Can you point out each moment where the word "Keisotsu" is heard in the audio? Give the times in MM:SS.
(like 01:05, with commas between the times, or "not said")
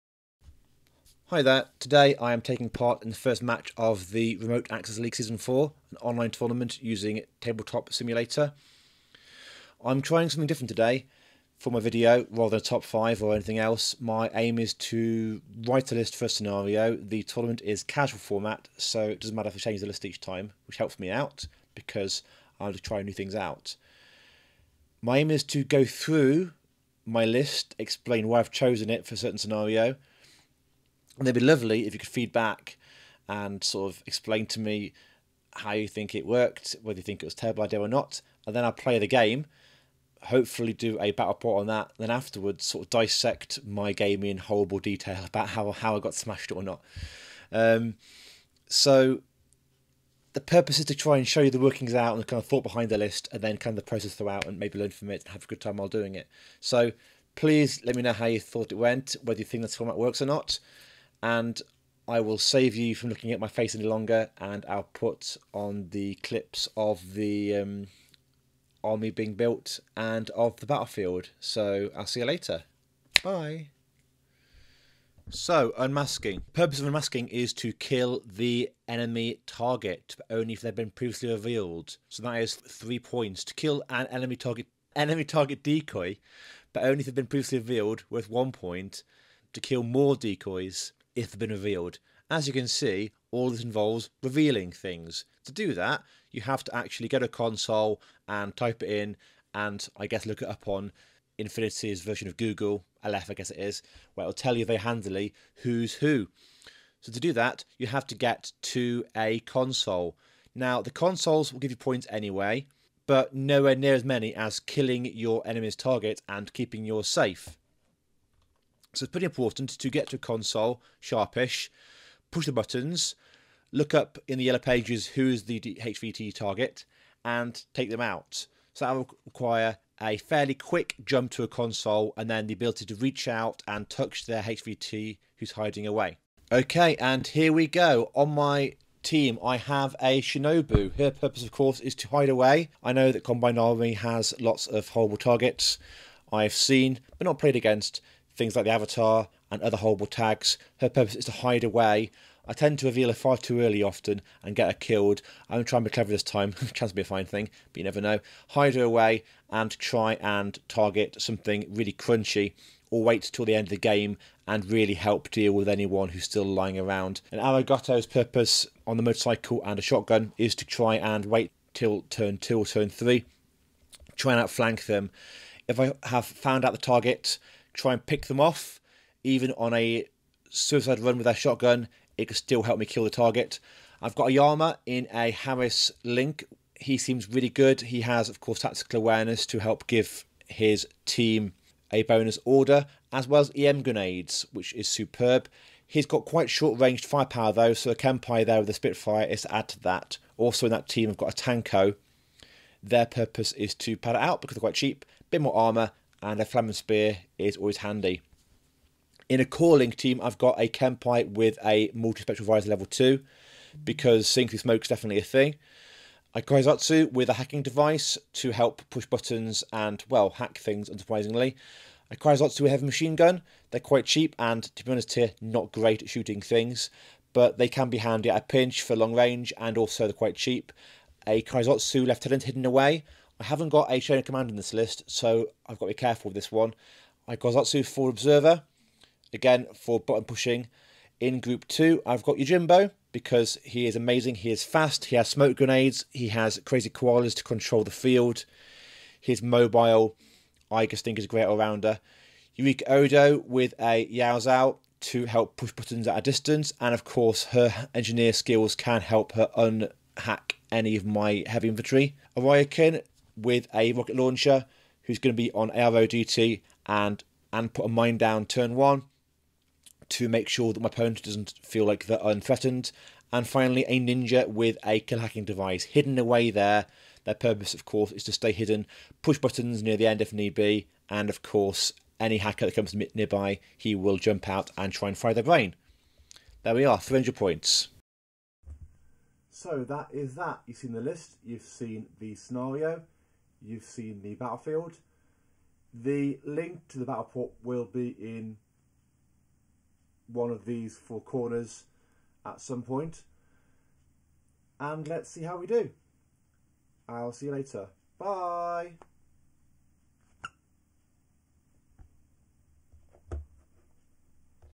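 03:36, 03:42, 03:51, 03:57.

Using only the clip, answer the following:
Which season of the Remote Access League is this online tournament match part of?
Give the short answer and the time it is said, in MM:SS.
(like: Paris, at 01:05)
Season 4, at 00:05.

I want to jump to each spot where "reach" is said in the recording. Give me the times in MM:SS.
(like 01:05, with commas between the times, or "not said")
02:12.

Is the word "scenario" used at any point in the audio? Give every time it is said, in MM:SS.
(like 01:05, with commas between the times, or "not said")
00:16, 00:29, 04:52.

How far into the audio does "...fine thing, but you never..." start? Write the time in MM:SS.
02:37.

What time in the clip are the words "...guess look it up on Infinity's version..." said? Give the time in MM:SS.
01:40.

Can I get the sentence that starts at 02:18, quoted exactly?
On my team, I have a Shinobu.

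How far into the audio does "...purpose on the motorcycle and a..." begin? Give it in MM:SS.
02:48.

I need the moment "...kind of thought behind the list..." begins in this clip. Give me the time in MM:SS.
00:52.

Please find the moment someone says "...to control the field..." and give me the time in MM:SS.
04:07.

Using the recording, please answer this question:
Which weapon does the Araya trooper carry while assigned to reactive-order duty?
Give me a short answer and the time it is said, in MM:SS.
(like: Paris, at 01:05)
Rocket launcher, at 04:23.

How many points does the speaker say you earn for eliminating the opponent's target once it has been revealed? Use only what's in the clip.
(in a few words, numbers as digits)
3.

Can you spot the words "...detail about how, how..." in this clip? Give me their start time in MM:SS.
00:44.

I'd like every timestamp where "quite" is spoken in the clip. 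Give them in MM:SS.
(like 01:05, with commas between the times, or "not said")
03:16, 03:24, 03:43, 03:50.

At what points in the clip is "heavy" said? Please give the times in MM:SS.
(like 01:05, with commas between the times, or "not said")
03:42, 04:21.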